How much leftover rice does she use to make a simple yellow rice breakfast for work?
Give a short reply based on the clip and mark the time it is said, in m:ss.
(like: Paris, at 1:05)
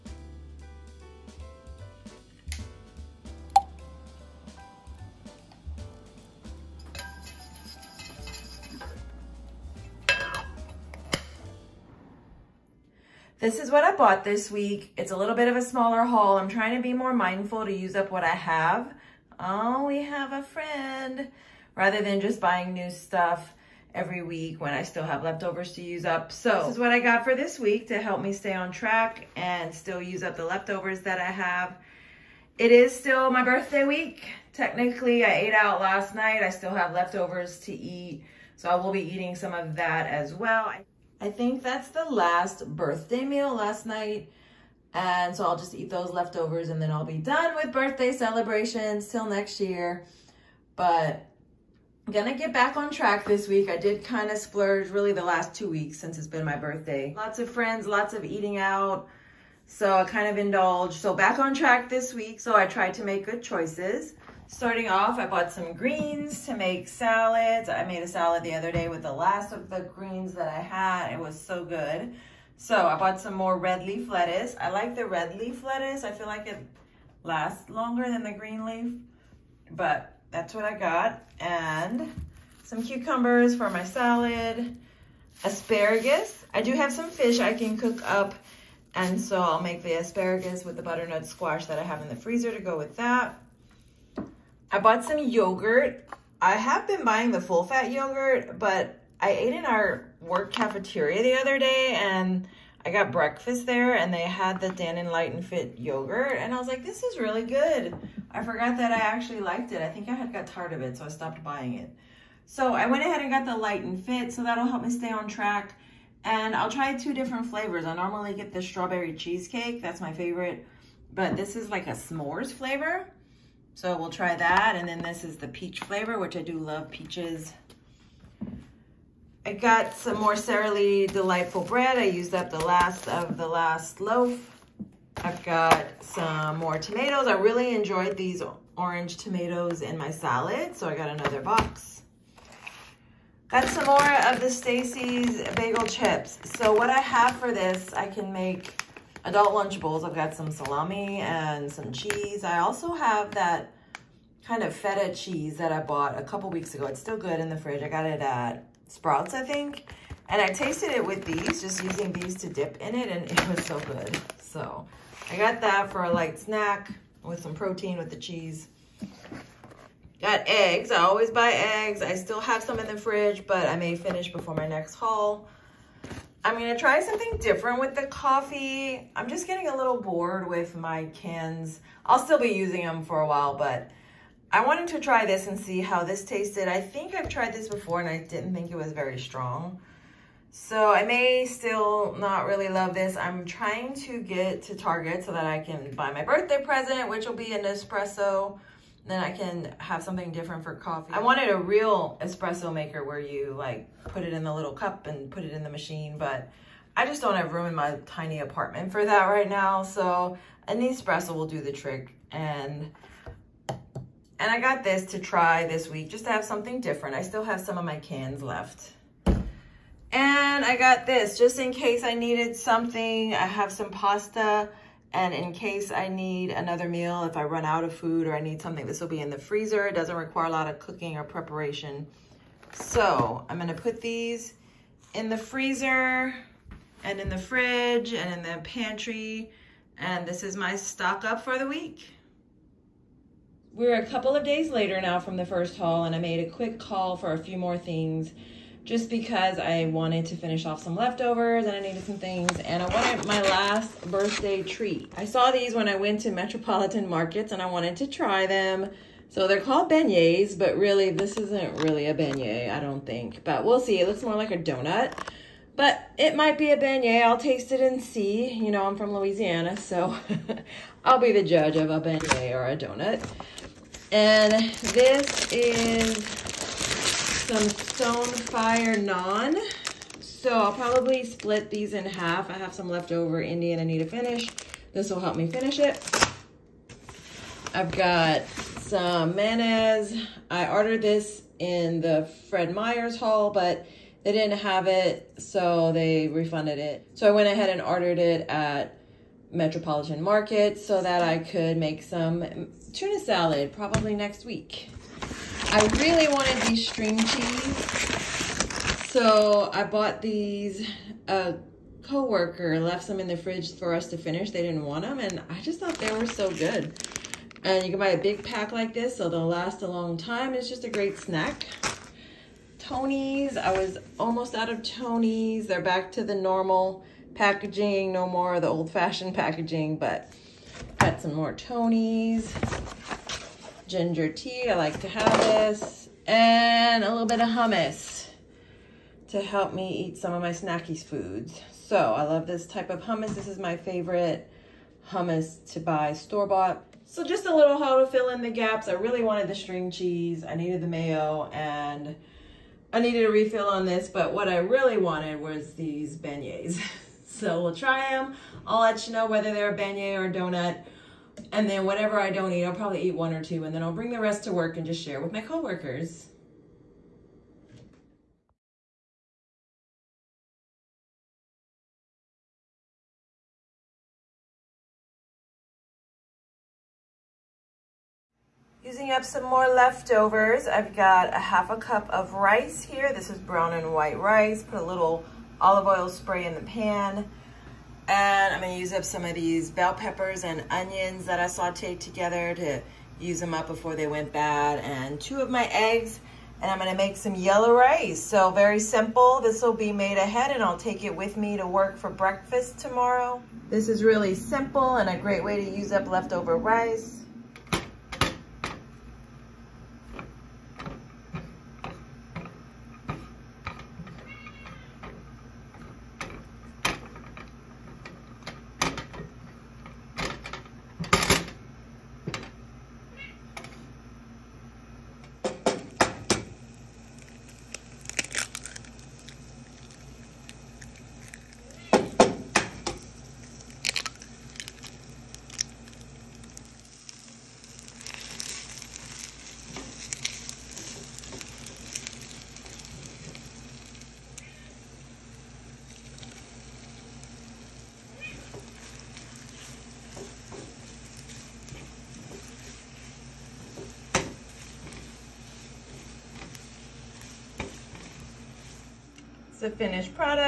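Half a cup, at 6:21.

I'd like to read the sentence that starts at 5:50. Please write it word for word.
I needed the mayo and I needed a refill on this, but what I really wanted was these beignets.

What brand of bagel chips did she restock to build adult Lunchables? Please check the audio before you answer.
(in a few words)
Stacy's.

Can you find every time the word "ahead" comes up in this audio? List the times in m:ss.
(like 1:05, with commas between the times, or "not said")
1:53, 4:57, 6:40.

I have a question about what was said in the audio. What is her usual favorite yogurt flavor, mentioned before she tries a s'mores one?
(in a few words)
Strawberry cheesecake.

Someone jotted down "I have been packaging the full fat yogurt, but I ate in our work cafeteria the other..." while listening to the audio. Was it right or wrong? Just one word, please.
wrong.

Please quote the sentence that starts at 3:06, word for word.
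I think I've tried this before and I didn't think it was very strong.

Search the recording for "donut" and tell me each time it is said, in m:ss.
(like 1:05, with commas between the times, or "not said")
4:24, 4:32, 6:00.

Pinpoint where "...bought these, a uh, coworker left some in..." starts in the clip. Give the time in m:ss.
5:09.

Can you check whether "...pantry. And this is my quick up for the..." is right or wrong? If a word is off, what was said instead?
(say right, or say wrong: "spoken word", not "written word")
wrong: "stock", not "quick".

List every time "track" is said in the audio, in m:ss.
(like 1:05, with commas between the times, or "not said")
0:28, 0:52, 1:01, 1:55.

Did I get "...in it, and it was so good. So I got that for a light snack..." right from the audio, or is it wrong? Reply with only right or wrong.
right.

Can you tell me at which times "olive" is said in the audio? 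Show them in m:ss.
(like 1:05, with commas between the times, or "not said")
6:25.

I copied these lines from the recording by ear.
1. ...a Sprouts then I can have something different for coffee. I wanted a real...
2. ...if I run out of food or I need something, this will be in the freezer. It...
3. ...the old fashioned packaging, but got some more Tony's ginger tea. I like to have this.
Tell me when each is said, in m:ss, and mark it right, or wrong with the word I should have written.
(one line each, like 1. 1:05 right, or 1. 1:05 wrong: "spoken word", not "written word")
1. 3:17 wrong: "Nespresso", not "Sprouts"
2. 3:47 right
3. 5:28 right.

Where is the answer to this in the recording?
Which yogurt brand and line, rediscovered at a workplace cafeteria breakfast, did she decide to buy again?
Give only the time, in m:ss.
1:44.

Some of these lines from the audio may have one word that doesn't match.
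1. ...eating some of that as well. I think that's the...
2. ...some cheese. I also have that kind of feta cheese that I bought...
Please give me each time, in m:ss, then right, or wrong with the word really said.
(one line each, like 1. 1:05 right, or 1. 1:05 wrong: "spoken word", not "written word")
1. 0:39 right
2. 2:31 right.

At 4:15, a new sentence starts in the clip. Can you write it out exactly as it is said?
I saw these when I went to Metropolitan Markets and I wanted to try them.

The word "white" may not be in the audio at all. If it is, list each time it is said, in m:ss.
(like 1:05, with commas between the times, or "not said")
6:23.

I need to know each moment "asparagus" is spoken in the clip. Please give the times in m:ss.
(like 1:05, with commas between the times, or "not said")
1:25, 1:29.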